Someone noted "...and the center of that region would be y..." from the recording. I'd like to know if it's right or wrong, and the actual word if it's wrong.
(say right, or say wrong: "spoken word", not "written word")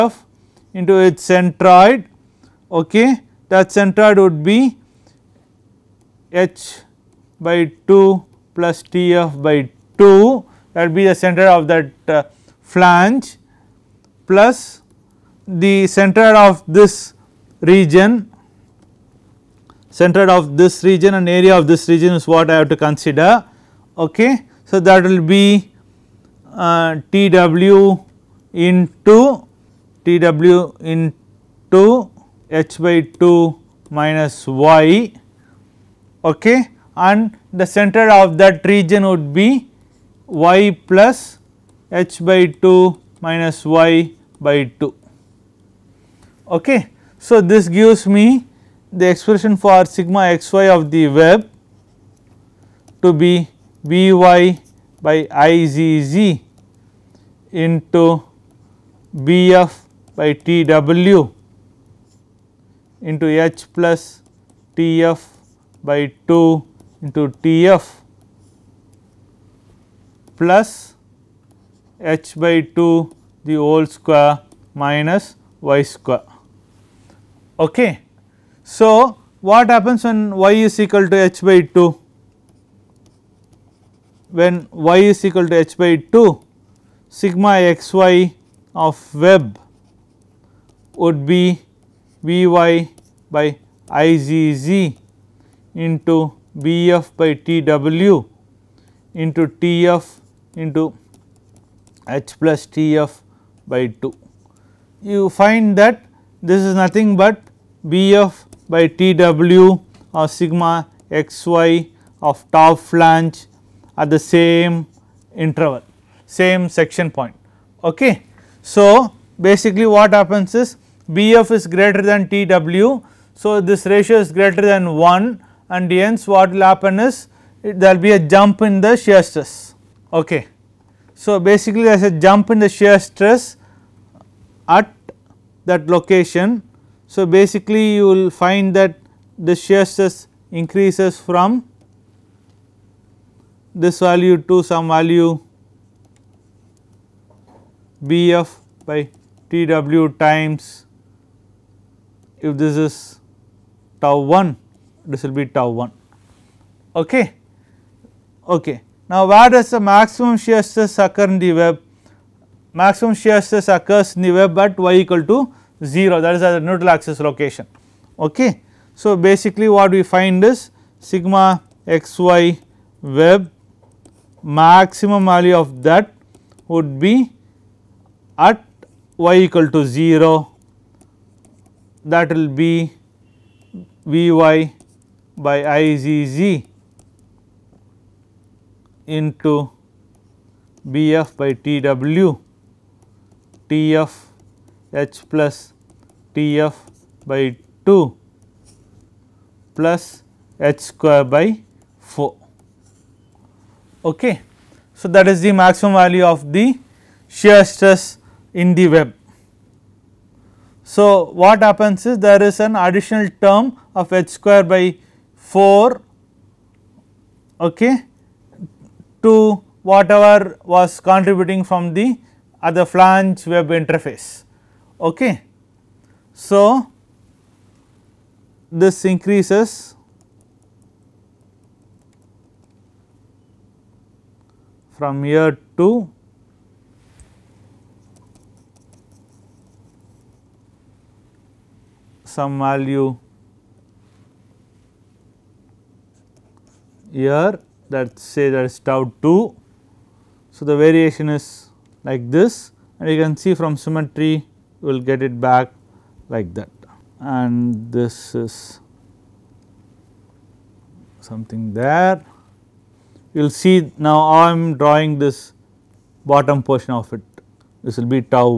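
right.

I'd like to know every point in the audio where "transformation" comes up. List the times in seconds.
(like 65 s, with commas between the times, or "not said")
not said.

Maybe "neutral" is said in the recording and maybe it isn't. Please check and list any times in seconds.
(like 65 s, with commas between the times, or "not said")
166 s.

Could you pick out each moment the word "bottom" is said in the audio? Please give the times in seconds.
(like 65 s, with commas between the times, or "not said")
266 s.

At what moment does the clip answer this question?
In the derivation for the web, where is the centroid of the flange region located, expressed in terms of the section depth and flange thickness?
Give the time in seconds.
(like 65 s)
6 s.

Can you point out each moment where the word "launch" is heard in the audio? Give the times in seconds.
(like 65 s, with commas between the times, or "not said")
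not said.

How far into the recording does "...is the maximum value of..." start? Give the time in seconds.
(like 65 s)
205 s.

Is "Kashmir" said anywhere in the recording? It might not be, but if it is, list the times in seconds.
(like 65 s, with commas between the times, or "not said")
not said.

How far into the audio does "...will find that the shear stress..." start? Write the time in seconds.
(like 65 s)
138 s.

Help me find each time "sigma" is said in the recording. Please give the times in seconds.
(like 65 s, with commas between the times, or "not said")
49 s, 87 s, 110 s, 171 s.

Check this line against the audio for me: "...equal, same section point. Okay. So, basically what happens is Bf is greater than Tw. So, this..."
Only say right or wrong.
wrong.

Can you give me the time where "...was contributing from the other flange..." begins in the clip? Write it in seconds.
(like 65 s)
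220 s.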